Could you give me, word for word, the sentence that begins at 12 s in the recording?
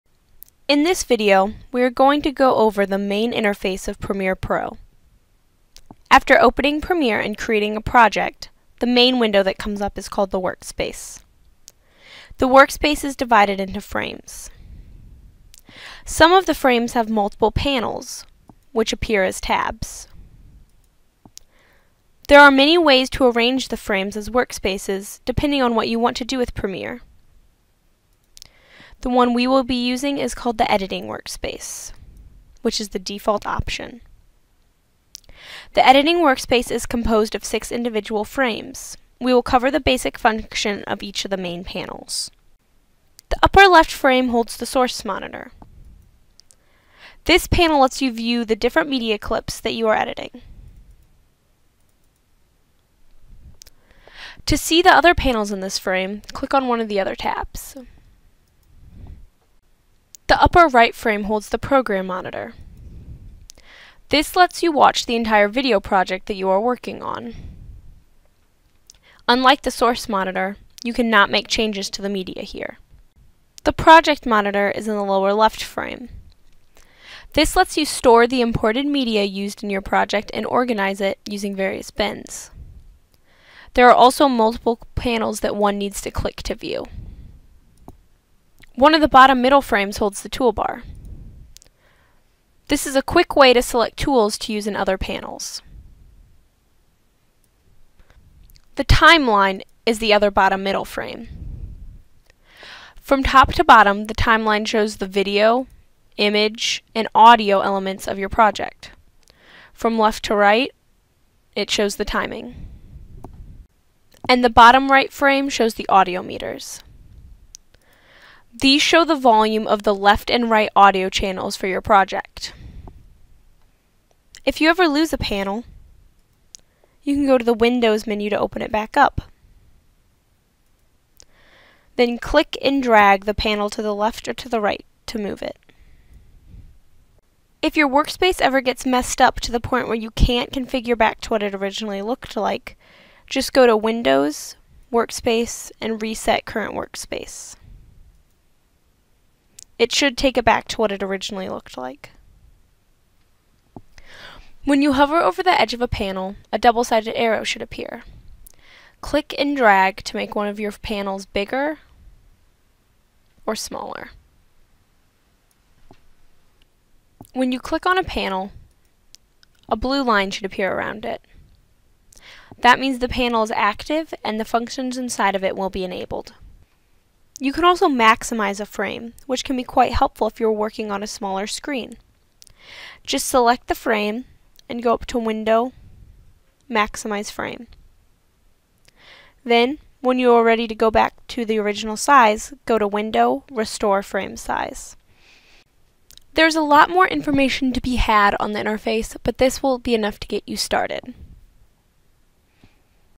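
The workspace is divided into frames.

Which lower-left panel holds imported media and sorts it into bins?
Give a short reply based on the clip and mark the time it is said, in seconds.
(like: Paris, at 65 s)
Project monitor, at 73 s.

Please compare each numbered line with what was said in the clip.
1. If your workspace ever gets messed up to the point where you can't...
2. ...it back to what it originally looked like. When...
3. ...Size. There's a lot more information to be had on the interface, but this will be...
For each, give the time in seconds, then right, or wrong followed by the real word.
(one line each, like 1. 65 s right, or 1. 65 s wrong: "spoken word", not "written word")
1. 137 s right
2. 150 s right
3. 194 s right.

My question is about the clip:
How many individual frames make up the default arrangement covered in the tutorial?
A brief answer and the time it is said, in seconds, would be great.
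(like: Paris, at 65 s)
6, at 37 s.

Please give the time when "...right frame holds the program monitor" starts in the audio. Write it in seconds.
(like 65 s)
60 s.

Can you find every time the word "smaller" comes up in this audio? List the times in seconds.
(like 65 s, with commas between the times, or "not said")
163 s, 181 s.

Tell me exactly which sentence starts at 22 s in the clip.
There are many ways to arrange the frames as workspaces, depending on what you want to do with Premiere.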